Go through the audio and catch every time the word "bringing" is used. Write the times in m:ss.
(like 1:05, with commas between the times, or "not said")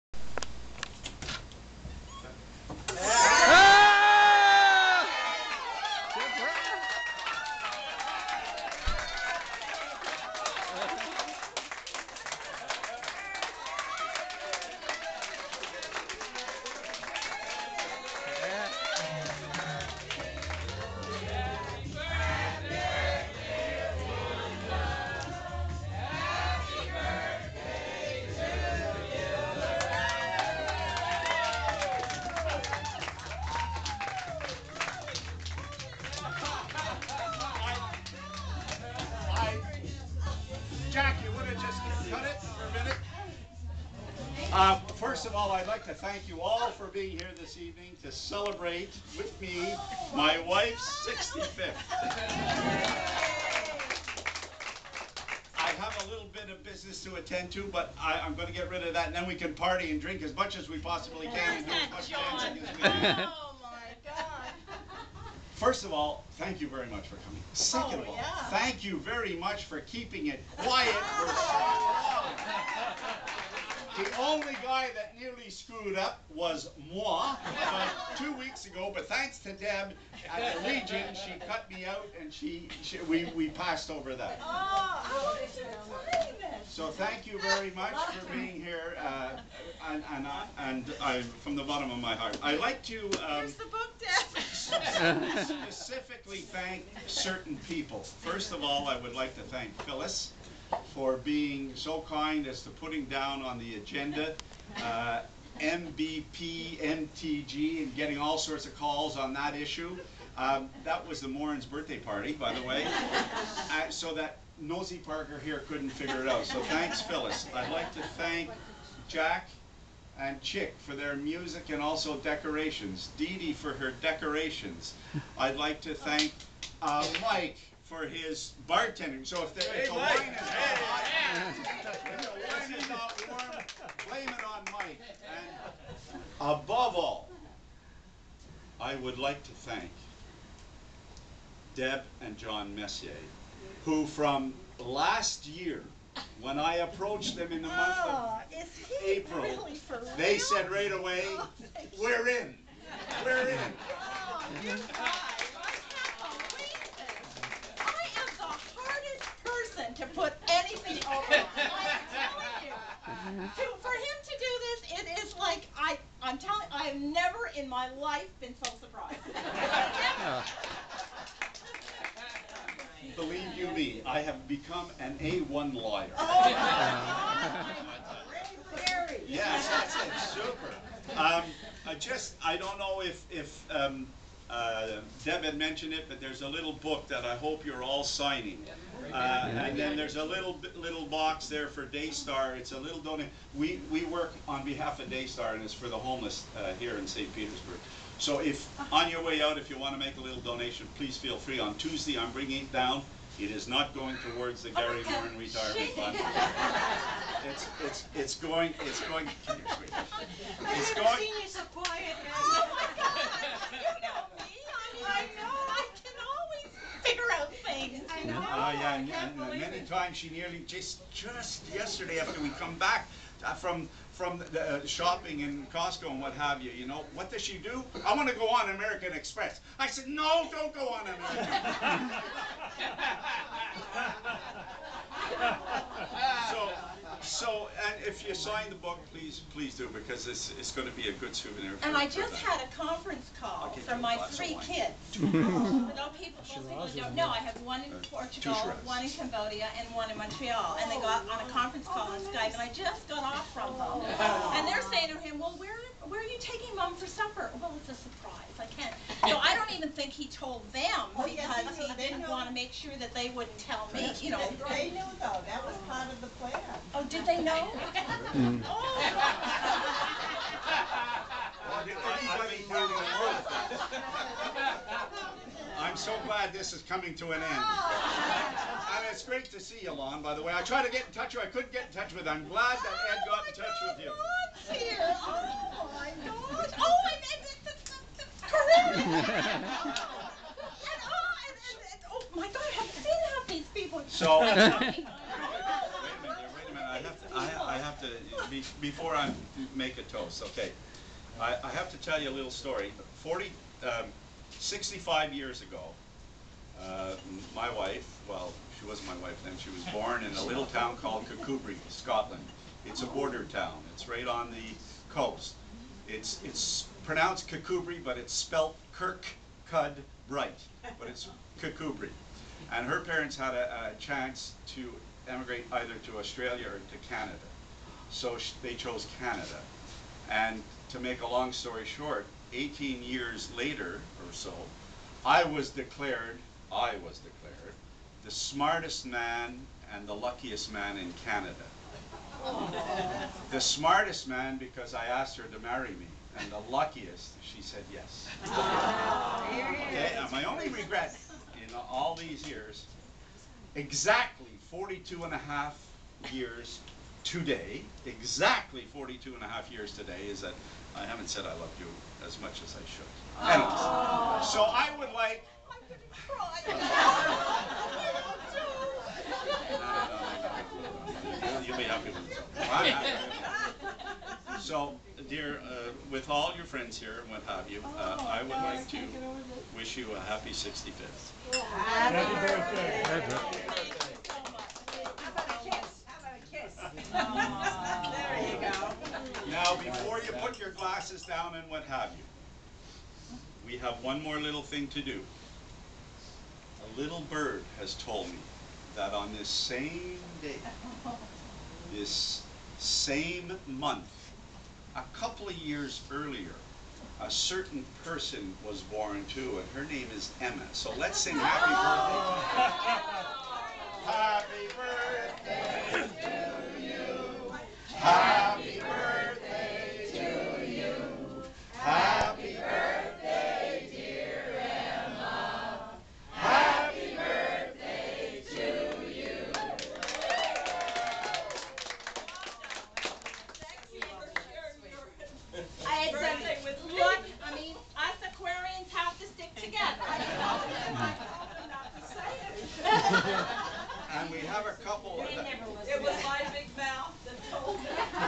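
3:22.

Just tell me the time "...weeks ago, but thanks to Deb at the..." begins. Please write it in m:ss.
1:18.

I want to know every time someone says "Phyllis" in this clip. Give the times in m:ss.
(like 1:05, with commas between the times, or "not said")
1:39, 1:57.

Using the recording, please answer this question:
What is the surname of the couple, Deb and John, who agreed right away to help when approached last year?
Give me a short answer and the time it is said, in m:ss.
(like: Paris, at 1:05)
Messier, at 2:22.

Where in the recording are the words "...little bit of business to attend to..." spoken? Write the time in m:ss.
0:56.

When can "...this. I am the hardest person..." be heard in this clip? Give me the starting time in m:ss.
2:36.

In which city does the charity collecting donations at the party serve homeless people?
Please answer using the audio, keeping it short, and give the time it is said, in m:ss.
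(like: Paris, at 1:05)
St. Petersburg, at 3:17.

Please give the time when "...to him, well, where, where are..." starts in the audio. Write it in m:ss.
4:15.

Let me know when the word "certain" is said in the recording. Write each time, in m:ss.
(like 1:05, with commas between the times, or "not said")
1:37, 6:47.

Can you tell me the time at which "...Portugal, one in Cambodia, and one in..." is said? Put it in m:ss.
4:08.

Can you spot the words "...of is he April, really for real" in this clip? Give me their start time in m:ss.
2:28.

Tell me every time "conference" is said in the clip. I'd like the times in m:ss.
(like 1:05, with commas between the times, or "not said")
4:02, 4:11.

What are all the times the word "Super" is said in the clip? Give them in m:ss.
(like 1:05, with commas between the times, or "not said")
3:00.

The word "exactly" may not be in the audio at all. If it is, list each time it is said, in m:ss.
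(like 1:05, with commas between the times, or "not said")
5:53, 5:58.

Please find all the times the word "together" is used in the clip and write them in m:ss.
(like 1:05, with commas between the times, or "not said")
7:19.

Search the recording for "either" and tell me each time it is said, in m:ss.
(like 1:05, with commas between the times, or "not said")
5:25.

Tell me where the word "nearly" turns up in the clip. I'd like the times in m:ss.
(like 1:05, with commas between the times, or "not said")
1:15, 3:40.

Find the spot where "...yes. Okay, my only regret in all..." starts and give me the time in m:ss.
5:47.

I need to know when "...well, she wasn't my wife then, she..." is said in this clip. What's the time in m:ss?
5:08.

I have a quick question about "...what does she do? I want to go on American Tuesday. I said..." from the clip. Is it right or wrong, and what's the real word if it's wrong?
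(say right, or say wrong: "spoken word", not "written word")
wrong: "Express", not "Tuesday".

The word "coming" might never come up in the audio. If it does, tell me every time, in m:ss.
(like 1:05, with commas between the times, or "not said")
1:07, 4:36.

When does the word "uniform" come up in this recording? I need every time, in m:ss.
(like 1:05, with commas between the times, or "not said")
not said.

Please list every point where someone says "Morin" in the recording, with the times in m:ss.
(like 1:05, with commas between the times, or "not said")
1:51.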